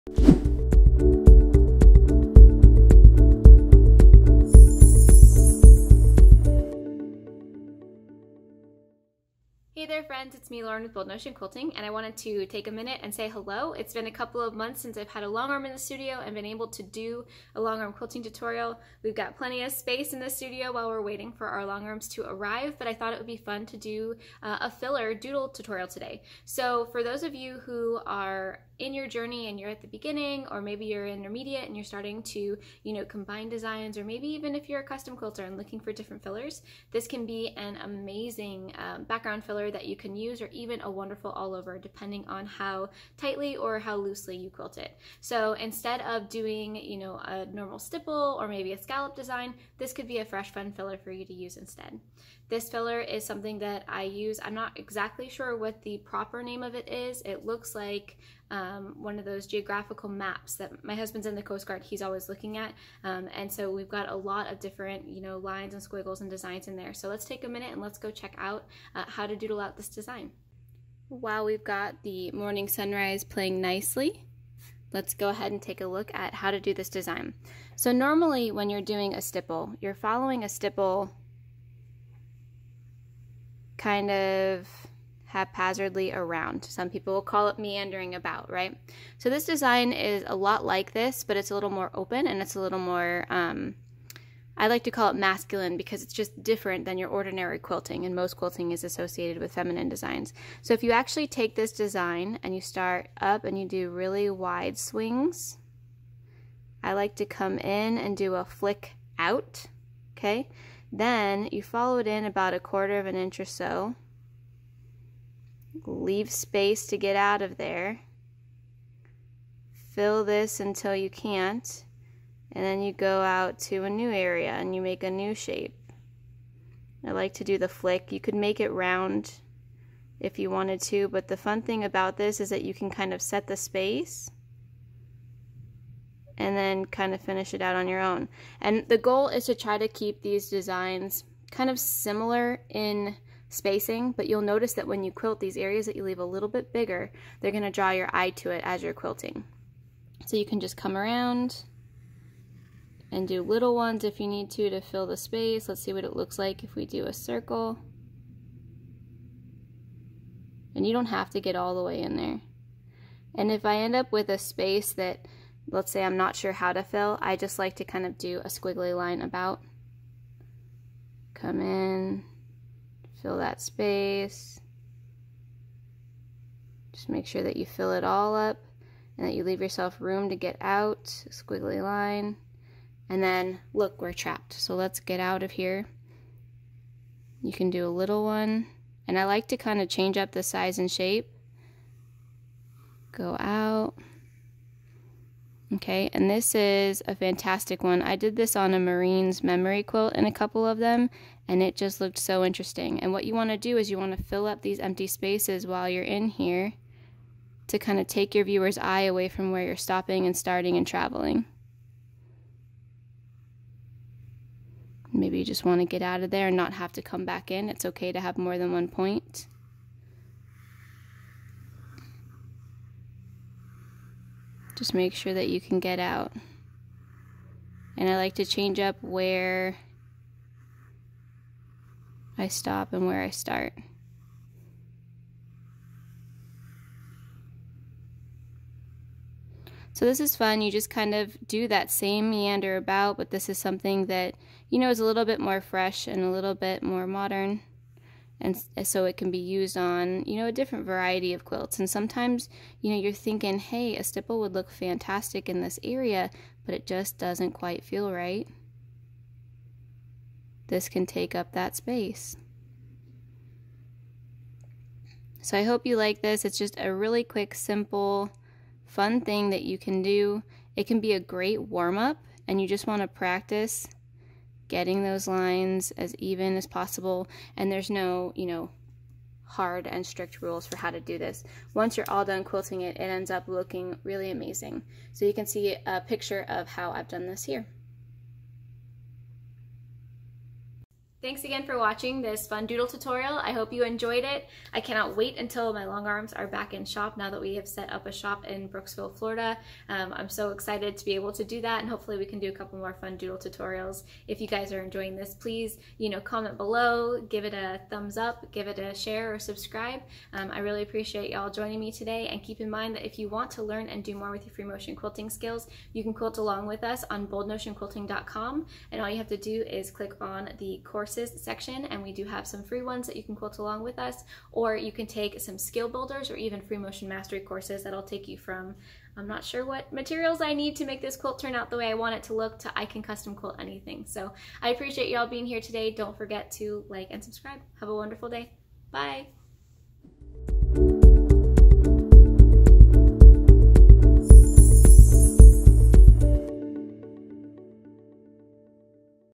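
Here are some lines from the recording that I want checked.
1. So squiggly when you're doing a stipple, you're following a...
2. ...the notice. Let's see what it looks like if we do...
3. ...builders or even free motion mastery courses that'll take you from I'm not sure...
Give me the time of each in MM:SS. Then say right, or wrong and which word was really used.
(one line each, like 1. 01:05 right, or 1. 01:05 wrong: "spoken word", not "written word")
1. 01:17 wrong: "normally", not "squiggly"
2. 02:35 wrong: "space", not "notice"
3. 05:25 right.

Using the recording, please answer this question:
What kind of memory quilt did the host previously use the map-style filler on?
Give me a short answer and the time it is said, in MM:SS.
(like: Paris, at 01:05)
Marine's memory quilt, at 03:18.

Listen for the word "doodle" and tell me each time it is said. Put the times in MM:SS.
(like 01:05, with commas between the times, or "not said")
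00:25, 01:09, 04:52, 05:03.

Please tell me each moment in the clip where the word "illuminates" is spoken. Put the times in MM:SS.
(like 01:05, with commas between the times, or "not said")
not said.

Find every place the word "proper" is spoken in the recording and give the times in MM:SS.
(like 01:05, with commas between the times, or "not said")
00:55.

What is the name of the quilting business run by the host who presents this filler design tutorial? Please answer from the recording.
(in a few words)
Bold Notion Quilting.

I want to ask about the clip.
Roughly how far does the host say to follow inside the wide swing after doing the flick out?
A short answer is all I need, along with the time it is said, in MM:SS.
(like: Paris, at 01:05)
a quarter of an inch, at 01:52.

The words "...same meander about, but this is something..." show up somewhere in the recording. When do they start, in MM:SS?
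04:01.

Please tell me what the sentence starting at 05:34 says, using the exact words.
So I appreciate y'all being here today.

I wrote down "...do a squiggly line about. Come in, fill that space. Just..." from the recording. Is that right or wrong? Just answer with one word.
right.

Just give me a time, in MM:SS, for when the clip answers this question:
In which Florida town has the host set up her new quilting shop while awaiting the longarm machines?
04:58.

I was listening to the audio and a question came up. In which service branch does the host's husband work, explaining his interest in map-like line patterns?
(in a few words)
Coast Guard.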